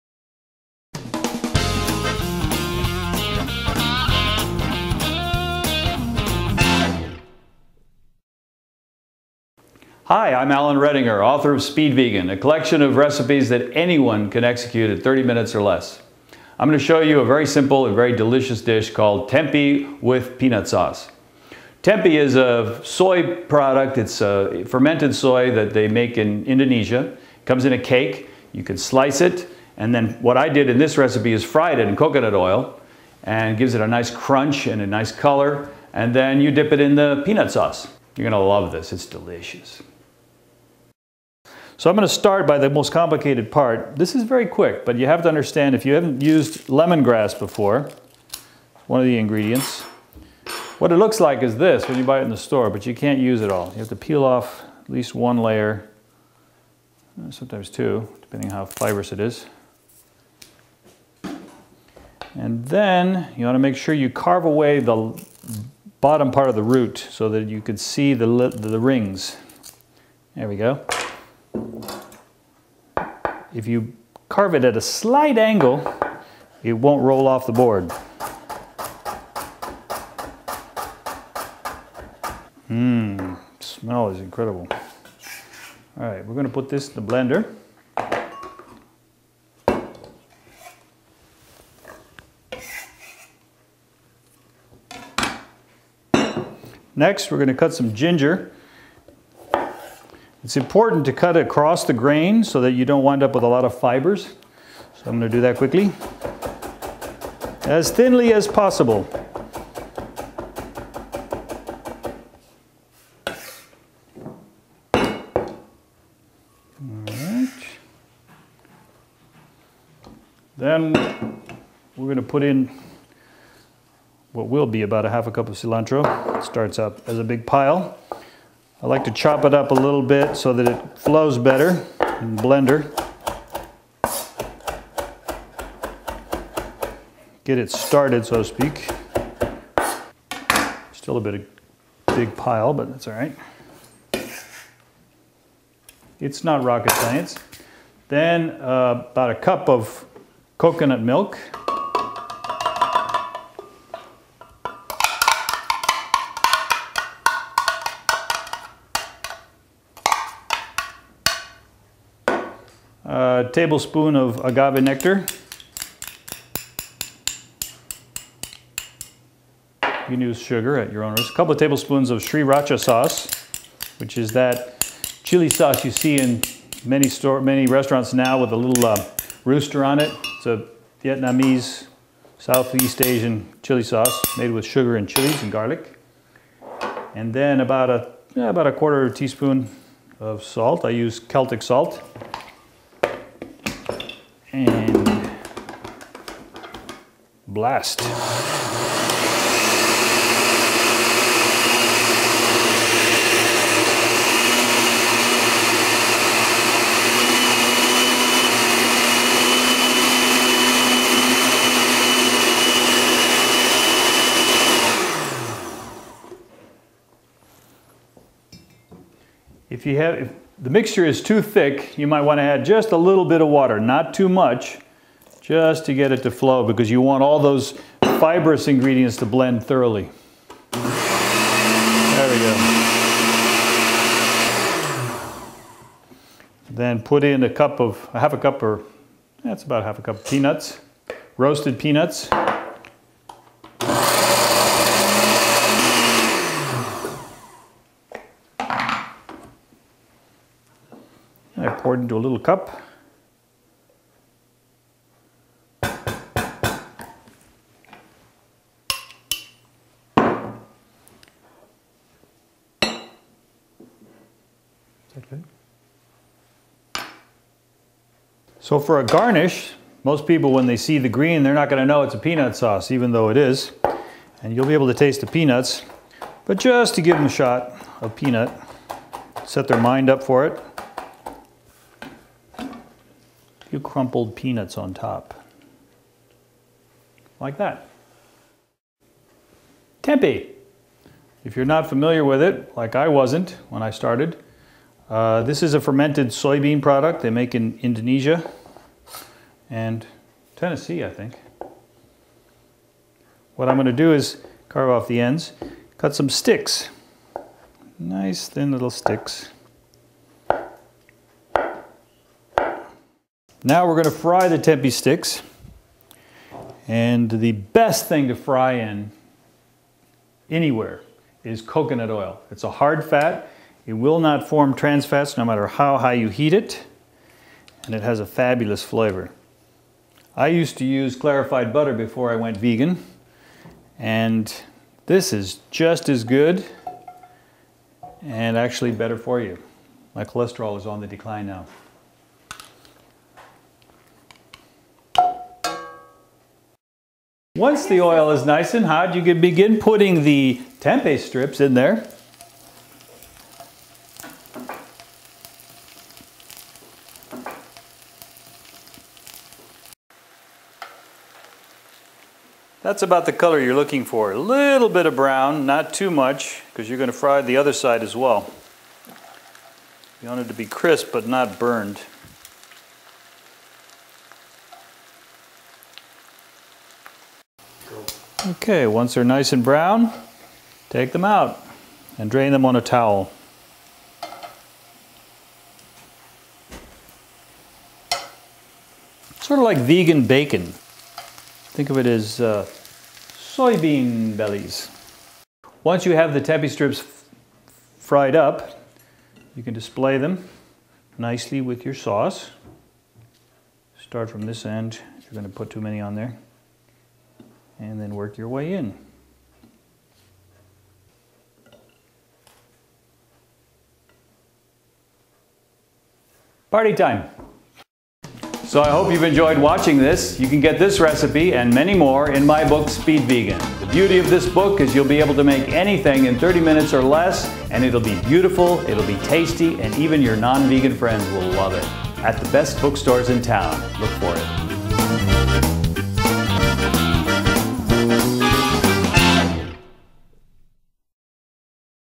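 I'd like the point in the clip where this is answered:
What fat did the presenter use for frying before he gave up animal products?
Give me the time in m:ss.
5:31.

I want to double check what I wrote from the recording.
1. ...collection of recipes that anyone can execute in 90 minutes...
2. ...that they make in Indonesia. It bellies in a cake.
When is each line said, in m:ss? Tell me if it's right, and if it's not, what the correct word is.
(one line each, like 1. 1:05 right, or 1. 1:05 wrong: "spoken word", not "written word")
1. 0:12 wrong: "30", not "90"
2. 0:25 wrong: "comes", not "bellies".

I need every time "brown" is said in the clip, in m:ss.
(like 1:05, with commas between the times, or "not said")
6:05, 6:19.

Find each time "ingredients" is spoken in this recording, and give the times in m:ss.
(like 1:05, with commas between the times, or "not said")
0:49, 3:48.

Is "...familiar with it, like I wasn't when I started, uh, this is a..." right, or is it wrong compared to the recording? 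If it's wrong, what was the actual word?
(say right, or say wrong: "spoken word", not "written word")
right.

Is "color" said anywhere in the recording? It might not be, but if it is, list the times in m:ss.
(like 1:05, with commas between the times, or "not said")
0:35, 6:03.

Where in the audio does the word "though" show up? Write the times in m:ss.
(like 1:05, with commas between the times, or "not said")
4:33.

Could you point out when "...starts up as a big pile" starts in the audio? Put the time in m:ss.
2:06.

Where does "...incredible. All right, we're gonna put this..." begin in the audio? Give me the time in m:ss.
1:24.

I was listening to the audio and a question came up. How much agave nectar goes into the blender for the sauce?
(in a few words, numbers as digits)
1 tablespoon.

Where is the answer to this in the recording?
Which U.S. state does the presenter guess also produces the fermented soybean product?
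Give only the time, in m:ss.
5:00.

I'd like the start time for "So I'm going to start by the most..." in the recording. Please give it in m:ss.
0:41.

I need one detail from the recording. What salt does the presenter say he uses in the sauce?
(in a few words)
Celtic salt.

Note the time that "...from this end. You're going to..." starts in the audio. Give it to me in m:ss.
6:44.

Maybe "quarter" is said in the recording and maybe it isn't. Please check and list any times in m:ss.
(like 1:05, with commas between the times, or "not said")
3:08.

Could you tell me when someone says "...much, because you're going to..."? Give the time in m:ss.
6:06.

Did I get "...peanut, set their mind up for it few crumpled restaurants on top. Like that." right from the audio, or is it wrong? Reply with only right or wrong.
wrong.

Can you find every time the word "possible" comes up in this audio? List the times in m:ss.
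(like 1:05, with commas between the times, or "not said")
1:48.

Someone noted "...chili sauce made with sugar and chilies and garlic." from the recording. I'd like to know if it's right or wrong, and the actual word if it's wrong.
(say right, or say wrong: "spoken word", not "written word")
right.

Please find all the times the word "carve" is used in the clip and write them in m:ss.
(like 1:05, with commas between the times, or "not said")
1:04, 1:14, 5:04.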